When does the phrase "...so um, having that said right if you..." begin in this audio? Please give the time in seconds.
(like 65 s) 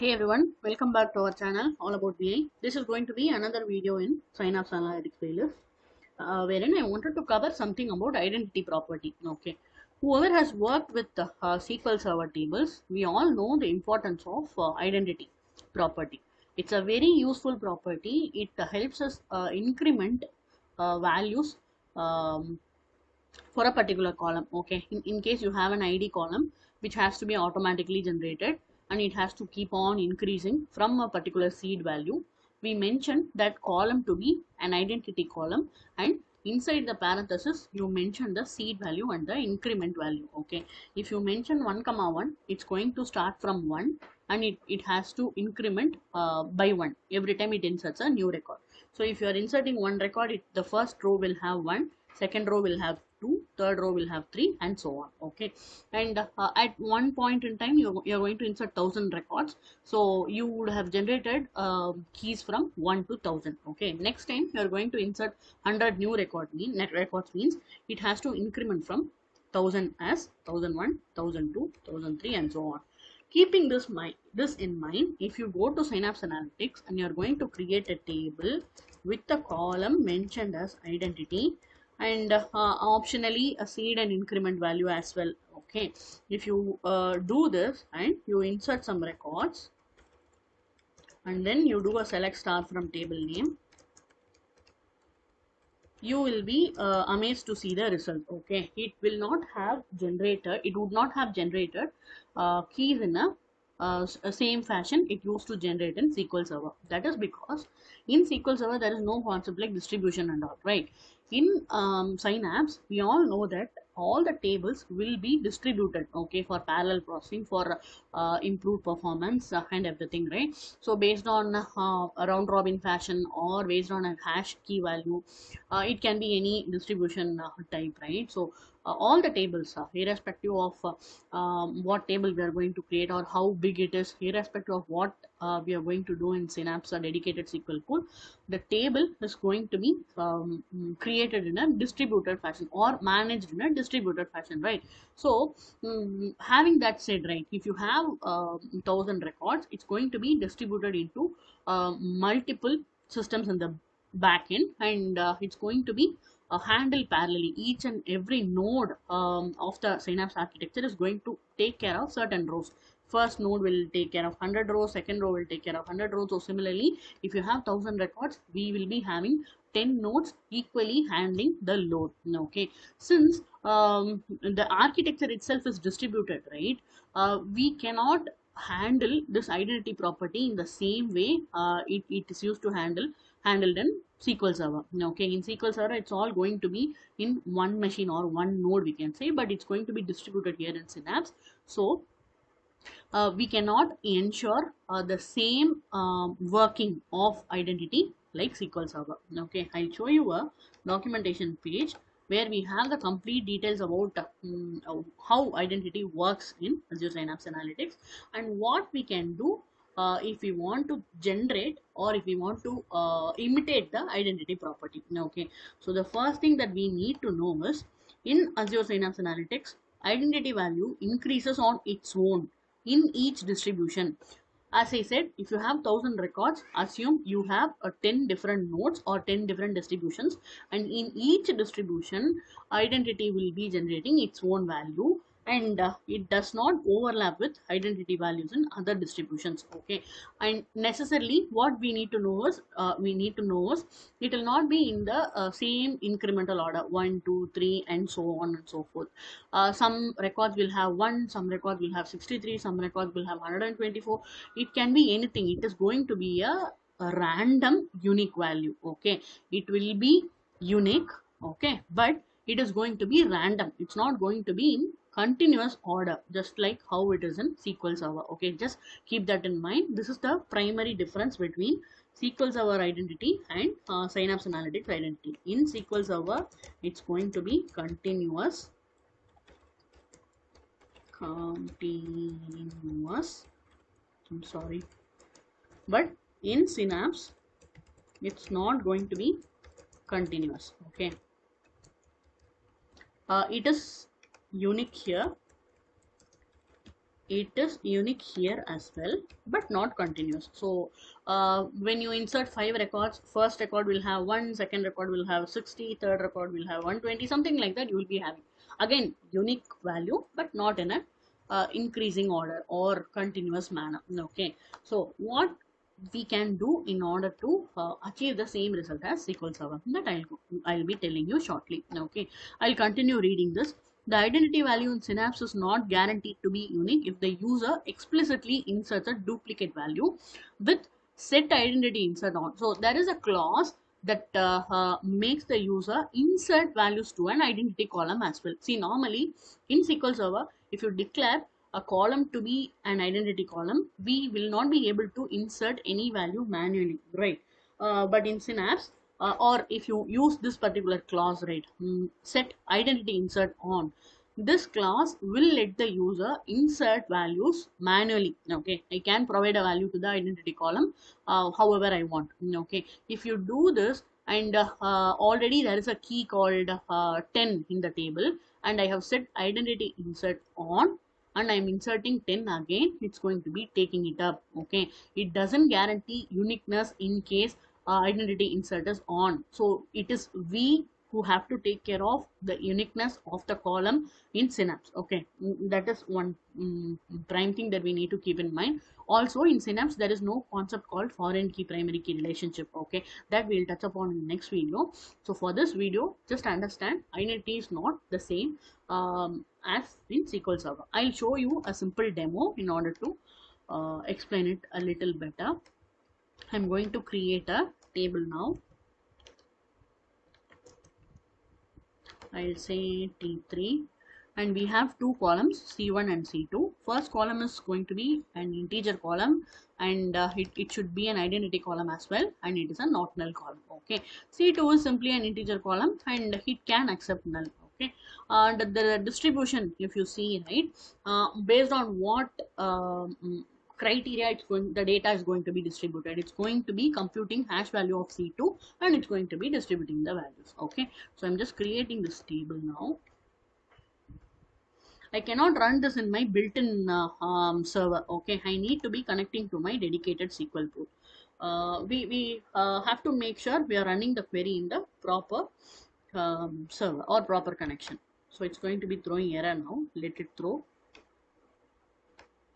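145 s.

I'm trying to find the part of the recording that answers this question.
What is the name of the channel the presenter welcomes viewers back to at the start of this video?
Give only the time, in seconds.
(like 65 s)
1 s.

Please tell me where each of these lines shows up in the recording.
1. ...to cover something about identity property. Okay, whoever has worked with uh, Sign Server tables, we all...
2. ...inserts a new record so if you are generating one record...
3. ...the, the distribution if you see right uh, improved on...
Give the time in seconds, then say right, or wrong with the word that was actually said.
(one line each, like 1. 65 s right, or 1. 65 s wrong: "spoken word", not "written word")
1. 7 s wrong: "SQL", not "Sign"
2. 47 s wrong: "inserting", not "generating"
3. 428 s wrong: "based", not "improved".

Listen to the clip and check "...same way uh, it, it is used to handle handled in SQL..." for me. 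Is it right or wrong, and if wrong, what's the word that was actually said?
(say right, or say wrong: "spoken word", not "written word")
right.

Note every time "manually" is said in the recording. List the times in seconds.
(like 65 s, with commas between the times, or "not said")
346 s, 357 s.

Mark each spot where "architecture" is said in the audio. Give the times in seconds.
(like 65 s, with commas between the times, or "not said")
160 s, 174 s.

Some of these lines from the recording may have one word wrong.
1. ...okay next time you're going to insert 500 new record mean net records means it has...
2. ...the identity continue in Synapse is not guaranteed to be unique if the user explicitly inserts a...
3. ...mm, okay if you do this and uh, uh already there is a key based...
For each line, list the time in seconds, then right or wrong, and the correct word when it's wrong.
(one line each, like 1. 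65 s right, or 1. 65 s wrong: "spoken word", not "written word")
1. 63 s wrong: "100", not "500"
2. 324 s wrong: "value", not "continue"
3. 362 s wrong: "called", not "based".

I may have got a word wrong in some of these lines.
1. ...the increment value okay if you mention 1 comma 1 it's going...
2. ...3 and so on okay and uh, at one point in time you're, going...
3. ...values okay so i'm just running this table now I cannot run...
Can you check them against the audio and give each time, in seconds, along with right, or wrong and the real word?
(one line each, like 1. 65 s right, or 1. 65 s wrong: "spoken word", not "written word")
1. 39 s right
2. 54 s right
3. 440 s wrong: "creating", not "running".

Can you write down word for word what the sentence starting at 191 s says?
So uh, we cannot ensure uh, the same um, working of identity like SQL Server.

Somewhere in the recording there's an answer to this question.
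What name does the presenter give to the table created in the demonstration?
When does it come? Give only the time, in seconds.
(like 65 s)
413 s.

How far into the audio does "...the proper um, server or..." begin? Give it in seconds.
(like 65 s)
454 s.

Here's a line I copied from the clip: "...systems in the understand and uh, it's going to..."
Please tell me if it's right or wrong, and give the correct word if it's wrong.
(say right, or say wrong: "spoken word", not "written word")
wrong: "backend", not "understand".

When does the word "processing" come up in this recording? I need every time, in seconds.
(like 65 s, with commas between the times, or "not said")
117 s.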